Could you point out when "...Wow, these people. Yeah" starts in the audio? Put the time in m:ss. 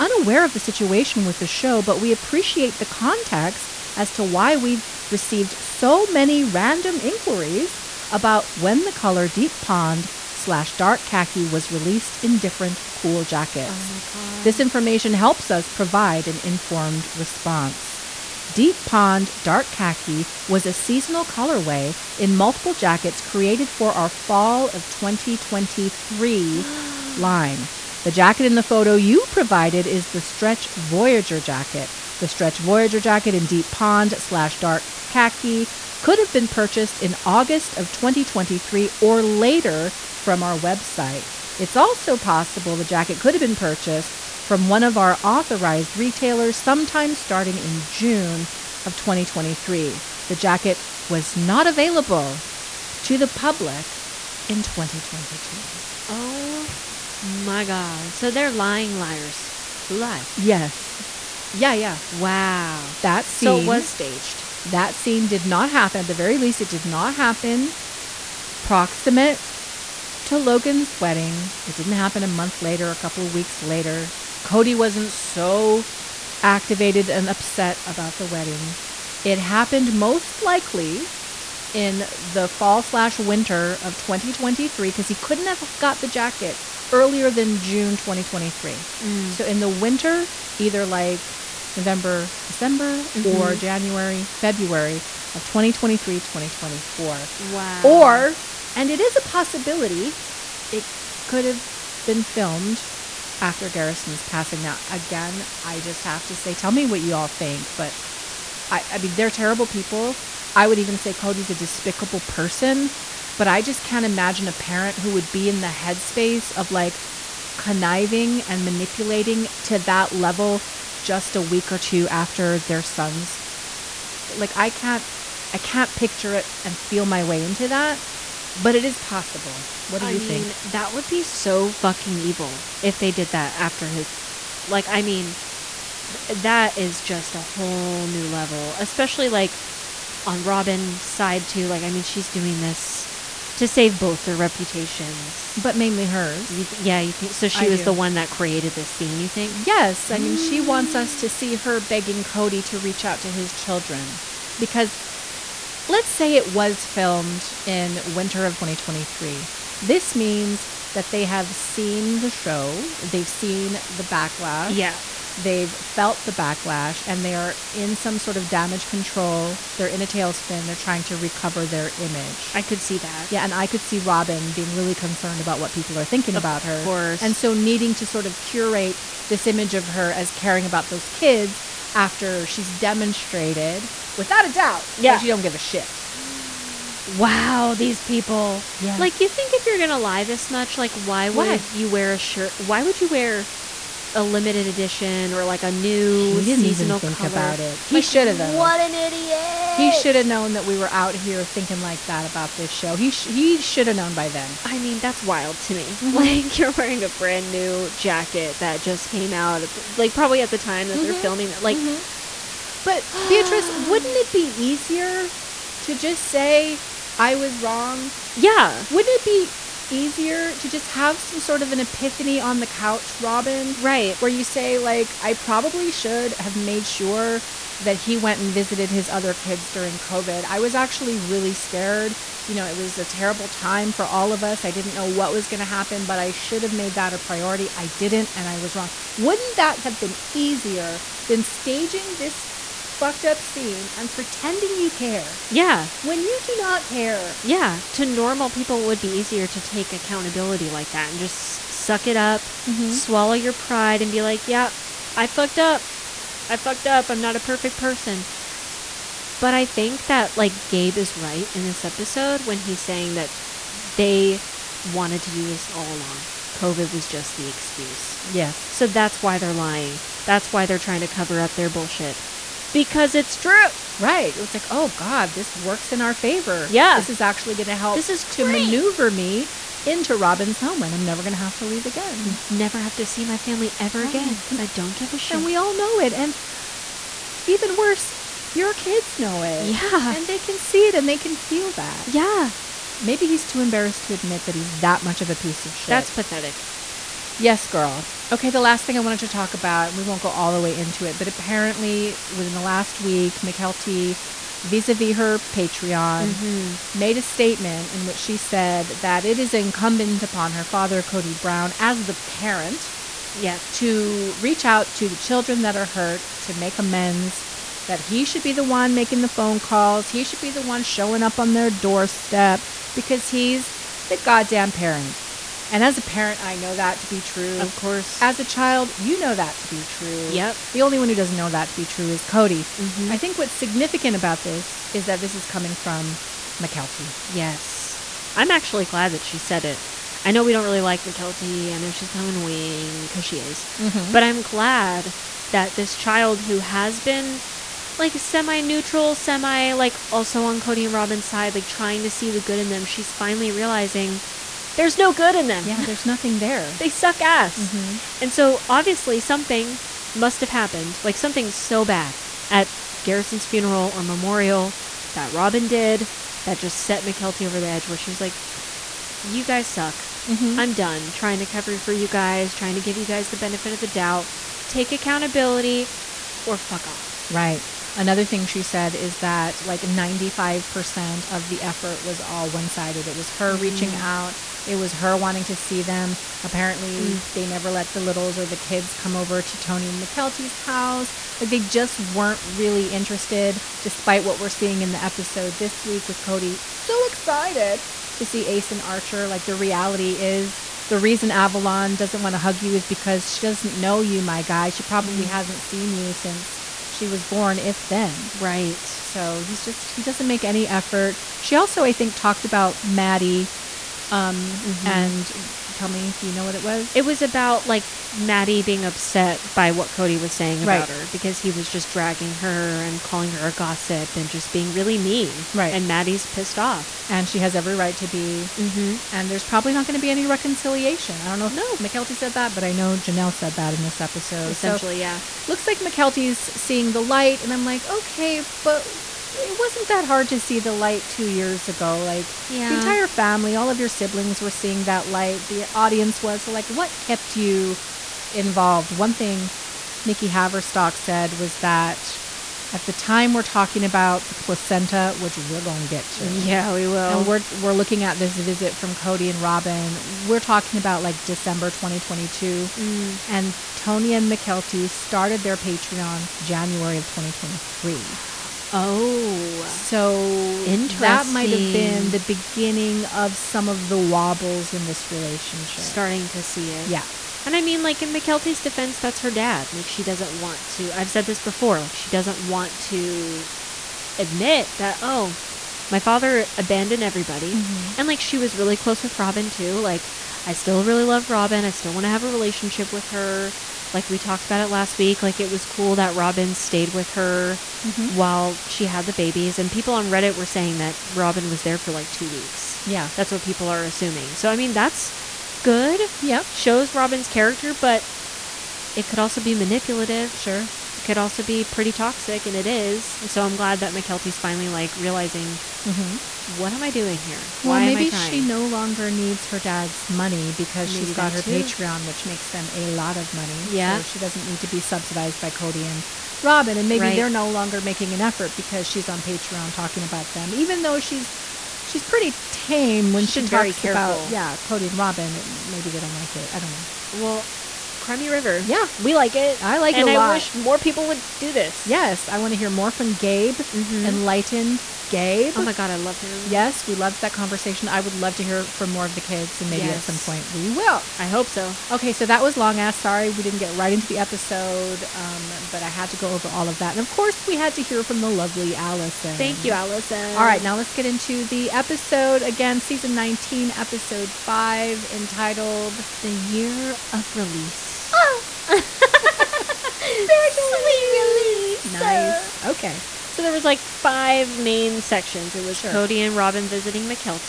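3:07.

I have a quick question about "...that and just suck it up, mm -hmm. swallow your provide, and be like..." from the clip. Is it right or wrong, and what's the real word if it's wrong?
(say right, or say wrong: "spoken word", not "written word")
wrong: "pride", not "provide".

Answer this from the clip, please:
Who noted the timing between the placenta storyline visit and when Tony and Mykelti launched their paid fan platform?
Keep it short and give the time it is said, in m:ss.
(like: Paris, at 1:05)
Nikki Haverstock, at 7:30.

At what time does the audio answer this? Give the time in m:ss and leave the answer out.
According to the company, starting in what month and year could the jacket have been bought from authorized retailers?
0:47.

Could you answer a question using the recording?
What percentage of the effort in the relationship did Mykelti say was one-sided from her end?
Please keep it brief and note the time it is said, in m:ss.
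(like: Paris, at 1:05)
95%, at 6:19.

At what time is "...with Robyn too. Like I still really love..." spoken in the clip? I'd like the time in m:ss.
8:09.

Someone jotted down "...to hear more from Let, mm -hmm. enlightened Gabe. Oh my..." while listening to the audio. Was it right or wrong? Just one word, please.
wrong.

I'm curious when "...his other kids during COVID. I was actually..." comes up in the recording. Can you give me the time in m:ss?
3:48.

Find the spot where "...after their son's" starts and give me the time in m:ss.
2:02.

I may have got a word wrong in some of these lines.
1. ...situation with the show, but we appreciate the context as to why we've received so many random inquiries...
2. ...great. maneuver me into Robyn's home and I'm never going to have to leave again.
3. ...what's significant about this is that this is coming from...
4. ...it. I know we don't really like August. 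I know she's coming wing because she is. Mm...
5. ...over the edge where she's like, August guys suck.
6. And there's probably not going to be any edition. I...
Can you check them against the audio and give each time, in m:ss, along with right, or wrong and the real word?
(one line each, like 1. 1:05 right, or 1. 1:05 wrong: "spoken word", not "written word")
1. 0:00 right
2. 4:38 right
3. 5:33 right
4. 5:39 wrong: "Mykelti", not "August"
5. 6:07 wrong: "You", not "August"
6. 7:09 wrong: "reconciliation", not "edition".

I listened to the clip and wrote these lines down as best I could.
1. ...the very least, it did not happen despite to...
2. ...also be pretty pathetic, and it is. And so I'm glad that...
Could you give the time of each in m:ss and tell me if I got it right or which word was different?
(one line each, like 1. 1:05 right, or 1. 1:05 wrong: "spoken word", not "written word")
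1. 1:06 wrong: "proximate", not "despite"
2. 8:31 wrong: "toxic", not "pathetic".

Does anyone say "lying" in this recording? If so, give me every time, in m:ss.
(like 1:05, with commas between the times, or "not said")
0:58, 4:29.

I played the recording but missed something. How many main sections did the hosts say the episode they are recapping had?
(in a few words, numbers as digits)
5.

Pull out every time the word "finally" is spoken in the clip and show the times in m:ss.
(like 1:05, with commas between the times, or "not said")
5:53, 8:34.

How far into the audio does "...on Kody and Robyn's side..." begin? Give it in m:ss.
5:50.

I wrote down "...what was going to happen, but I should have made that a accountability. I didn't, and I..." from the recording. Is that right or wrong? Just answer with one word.
wrong.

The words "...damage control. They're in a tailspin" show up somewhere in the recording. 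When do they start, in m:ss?
2:48.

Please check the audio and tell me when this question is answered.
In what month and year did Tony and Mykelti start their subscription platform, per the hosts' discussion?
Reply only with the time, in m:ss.
7:46.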